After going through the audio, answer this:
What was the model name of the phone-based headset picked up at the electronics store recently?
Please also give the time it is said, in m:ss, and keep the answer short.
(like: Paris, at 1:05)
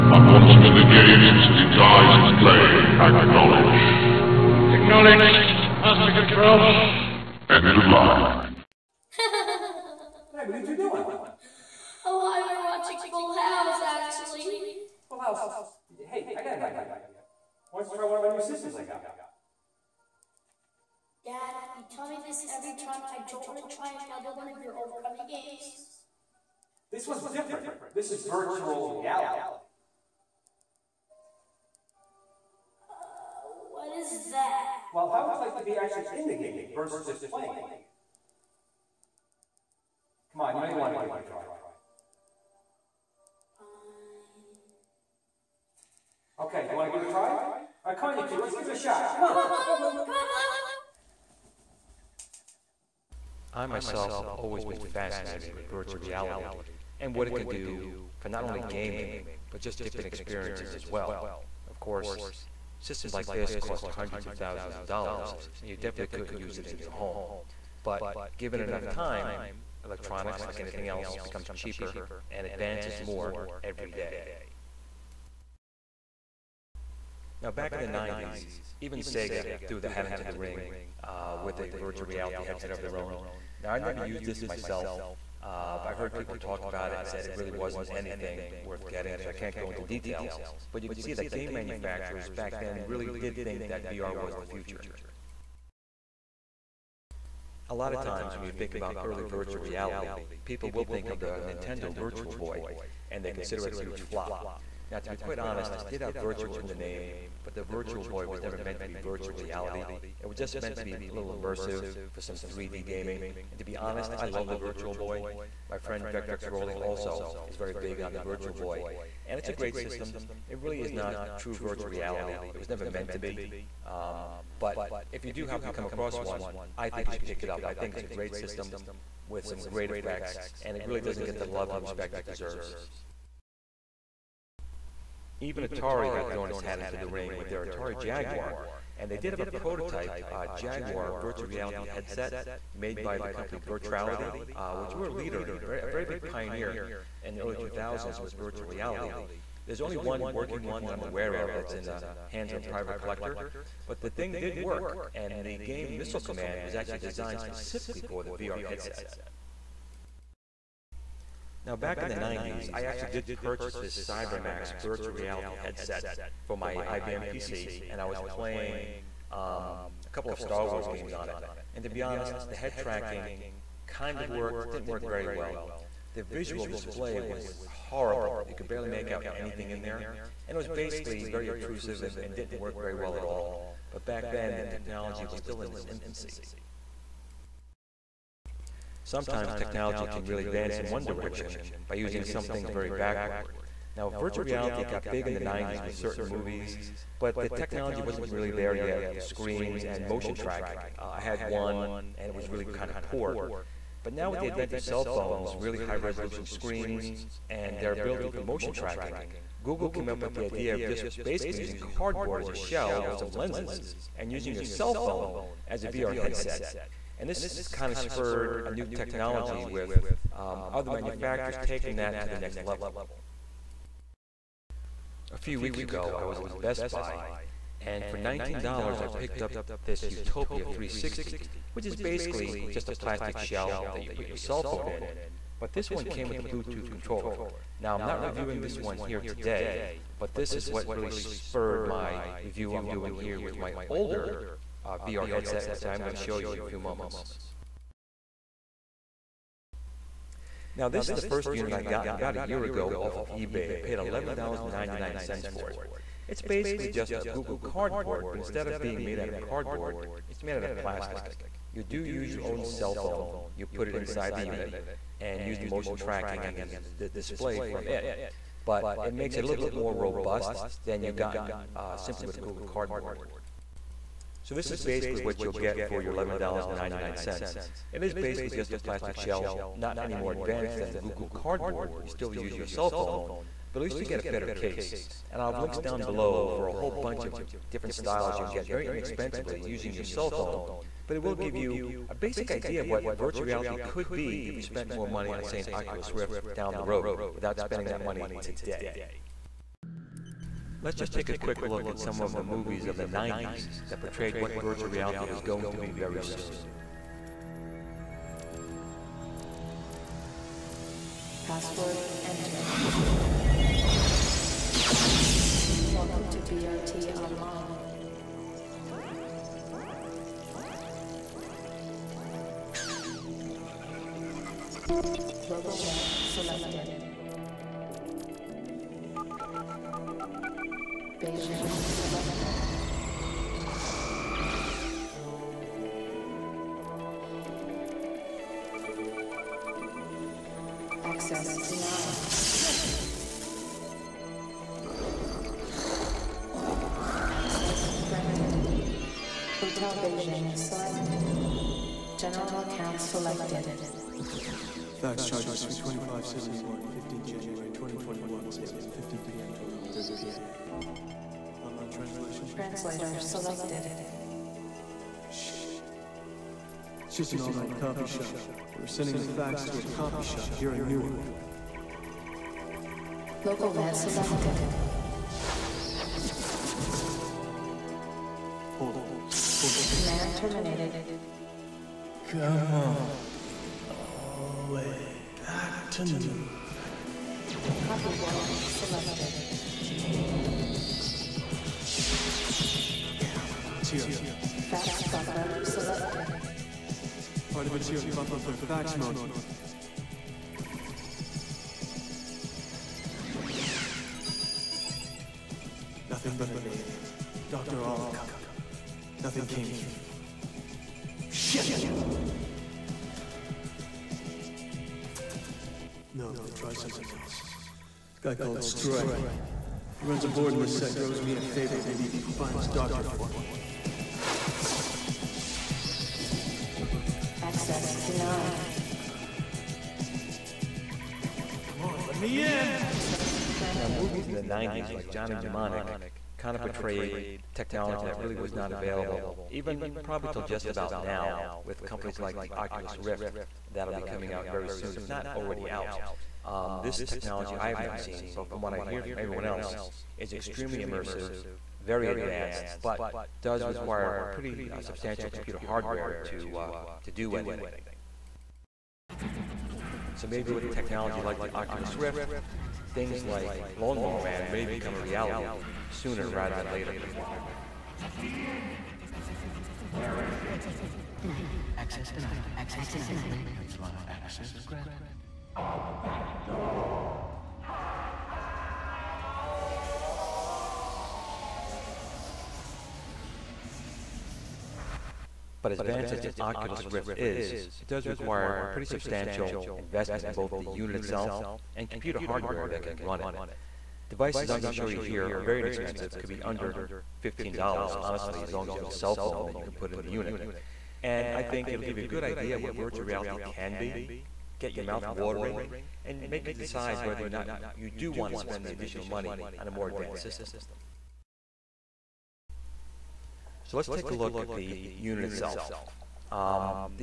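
Utopia 360, at 3:50.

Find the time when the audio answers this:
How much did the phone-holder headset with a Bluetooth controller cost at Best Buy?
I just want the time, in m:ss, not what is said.
3:48.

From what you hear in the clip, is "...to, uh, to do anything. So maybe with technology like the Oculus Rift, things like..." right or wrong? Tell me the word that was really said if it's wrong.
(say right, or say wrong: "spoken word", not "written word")
right.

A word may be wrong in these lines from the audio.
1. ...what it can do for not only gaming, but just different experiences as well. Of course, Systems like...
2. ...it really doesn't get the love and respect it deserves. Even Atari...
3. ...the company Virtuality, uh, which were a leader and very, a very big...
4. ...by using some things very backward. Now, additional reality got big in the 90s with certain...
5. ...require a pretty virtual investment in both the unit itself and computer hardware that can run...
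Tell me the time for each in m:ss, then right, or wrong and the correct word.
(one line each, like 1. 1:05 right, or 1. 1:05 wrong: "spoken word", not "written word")
1. 0:57 right
2. 2:10 right
3. 2:23 right
4. 3:11 wrong: "virtual", not "additional"
5. 8:08 wrong: "substantial", not "virtual".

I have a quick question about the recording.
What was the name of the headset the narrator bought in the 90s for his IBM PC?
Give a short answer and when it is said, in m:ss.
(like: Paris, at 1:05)
CyberMaxx, at 2:43.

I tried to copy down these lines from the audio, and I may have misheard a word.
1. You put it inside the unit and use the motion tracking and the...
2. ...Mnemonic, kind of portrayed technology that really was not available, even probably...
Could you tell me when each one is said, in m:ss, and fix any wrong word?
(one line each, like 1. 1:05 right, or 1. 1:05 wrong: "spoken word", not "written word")
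1. 4:23 right
2. 7:15 right.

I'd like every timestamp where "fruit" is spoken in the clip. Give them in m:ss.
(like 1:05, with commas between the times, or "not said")
not said.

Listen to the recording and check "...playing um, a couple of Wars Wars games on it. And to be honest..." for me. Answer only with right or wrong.
wrong.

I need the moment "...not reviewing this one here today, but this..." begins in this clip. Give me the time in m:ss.
3:58.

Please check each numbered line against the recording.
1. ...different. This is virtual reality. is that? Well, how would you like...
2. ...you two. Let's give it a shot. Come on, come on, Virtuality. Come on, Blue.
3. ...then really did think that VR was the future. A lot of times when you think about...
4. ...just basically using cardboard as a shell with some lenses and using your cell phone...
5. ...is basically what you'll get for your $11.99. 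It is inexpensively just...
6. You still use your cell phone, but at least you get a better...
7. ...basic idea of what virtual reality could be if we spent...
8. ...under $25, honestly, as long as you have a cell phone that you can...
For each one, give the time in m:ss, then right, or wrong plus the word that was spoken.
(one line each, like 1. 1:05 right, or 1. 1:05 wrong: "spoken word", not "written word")
1. 0:27 right
2. 0:48 wrong: "Blue", not "Virtuality"
3. 1:32 right
4. 3:30 right
5. 4:34 wrong: "basically", not "inexpensively"
6. 4:42 right
7. 4:52 right
8. 8:16 wrong: "15", not "25".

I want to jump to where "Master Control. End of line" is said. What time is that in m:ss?
0:05.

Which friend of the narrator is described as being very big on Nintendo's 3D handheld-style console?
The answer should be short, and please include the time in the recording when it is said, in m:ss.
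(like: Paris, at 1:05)
Vectrex Roli, at 1:56.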